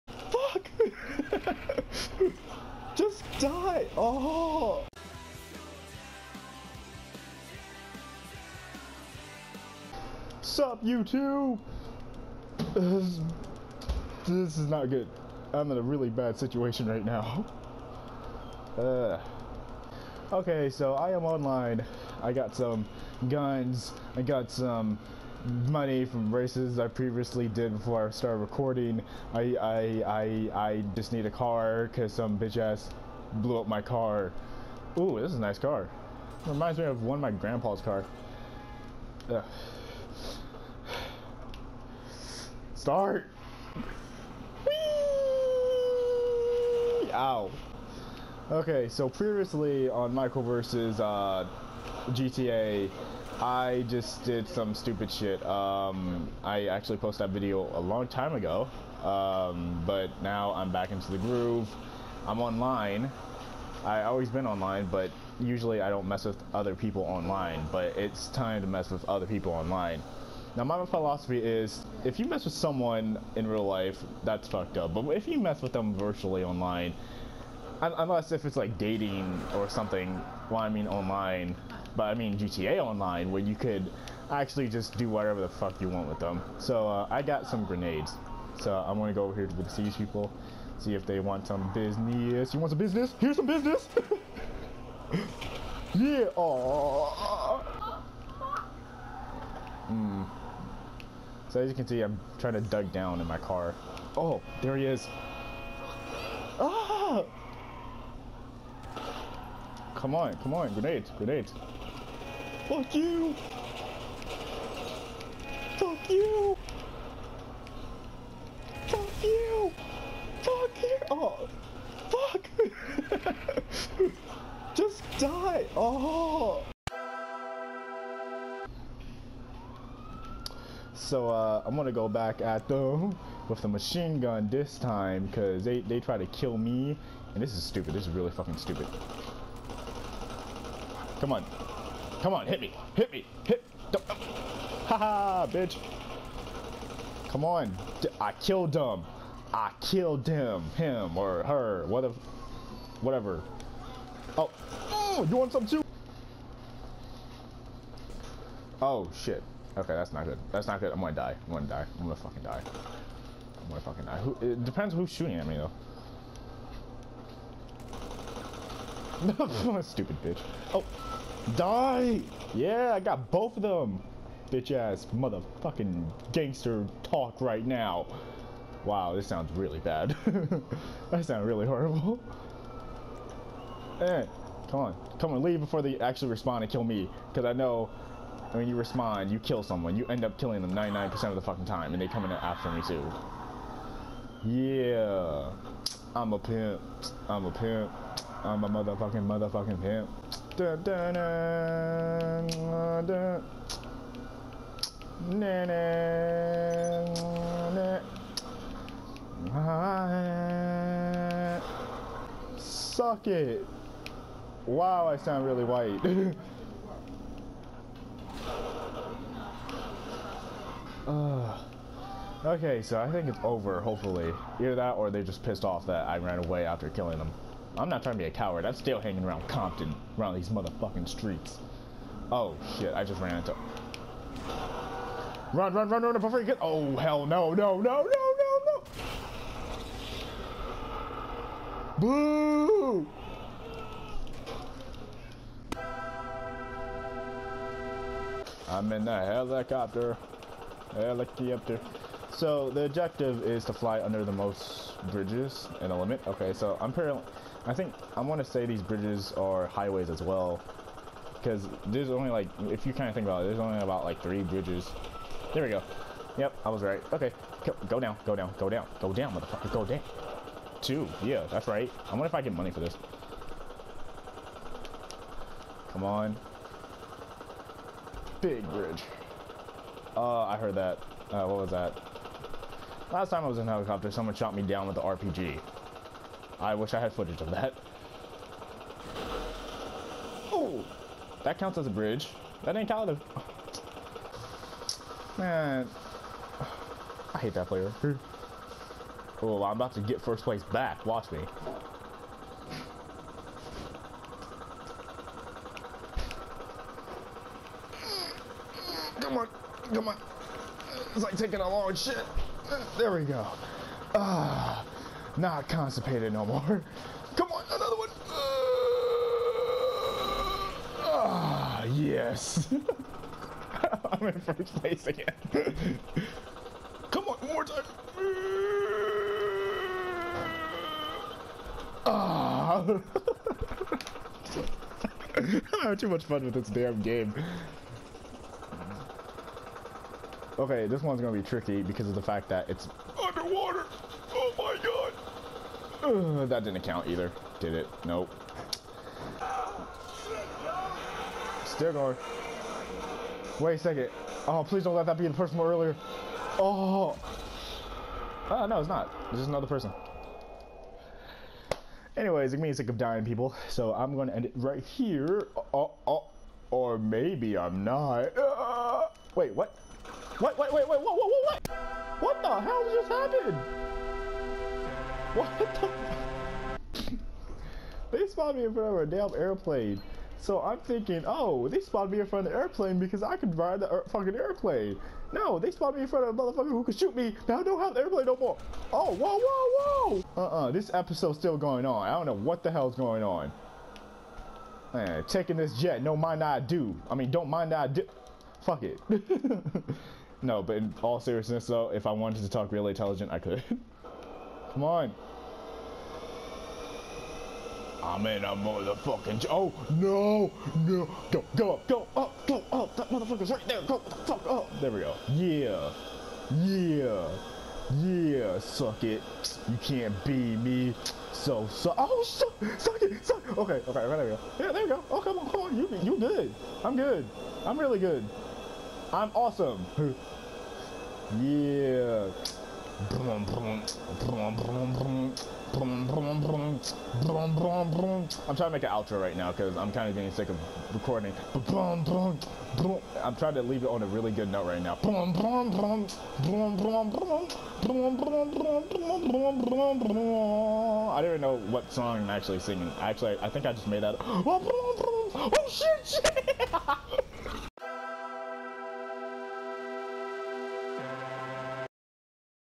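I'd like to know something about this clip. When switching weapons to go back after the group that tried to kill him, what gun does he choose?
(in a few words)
machine gun.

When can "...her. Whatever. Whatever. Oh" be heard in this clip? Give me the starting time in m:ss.
2:31.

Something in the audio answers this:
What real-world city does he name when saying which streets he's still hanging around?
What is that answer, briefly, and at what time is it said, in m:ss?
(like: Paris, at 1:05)
Compton, at 3:49.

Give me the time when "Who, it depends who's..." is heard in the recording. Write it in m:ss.
2:44.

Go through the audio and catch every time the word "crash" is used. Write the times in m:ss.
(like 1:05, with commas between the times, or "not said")
not said.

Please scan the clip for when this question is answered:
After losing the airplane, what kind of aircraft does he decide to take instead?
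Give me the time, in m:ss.
6:35.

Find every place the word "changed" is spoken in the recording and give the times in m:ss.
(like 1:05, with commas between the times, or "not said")
not said.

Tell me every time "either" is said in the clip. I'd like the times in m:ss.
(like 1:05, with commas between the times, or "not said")
3:44, 5:47.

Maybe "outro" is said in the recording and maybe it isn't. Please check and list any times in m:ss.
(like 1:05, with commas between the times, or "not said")
7:18.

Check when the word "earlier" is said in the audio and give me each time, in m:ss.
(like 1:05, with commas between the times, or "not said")
5:55.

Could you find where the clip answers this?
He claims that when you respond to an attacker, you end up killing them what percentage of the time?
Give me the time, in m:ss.
3:10.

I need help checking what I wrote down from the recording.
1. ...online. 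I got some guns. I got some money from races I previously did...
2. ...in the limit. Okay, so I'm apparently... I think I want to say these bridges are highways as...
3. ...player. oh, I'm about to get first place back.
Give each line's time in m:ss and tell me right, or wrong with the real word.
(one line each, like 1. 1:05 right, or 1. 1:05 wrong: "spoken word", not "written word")
1. 0:21 right
2. 4:15 right
3. 4:57 right.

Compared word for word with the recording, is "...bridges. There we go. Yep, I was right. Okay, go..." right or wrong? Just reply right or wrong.
right.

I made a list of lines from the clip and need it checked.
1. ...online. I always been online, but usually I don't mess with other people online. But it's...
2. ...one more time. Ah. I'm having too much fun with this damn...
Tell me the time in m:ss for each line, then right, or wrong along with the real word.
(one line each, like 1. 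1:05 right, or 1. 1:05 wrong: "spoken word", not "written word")
1. 1:02 right
2. 5:27 right.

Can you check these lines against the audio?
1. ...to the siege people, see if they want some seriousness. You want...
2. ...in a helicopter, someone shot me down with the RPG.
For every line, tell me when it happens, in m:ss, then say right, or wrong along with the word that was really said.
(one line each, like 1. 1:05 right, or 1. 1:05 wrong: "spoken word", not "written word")
1. 1:29 wrong: "business", not "seriousness"
2. 4:43 right.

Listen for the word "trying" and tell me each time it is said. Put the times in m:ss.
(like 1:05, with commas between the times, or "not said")
1:42, 3:48, 7:13, 7:21.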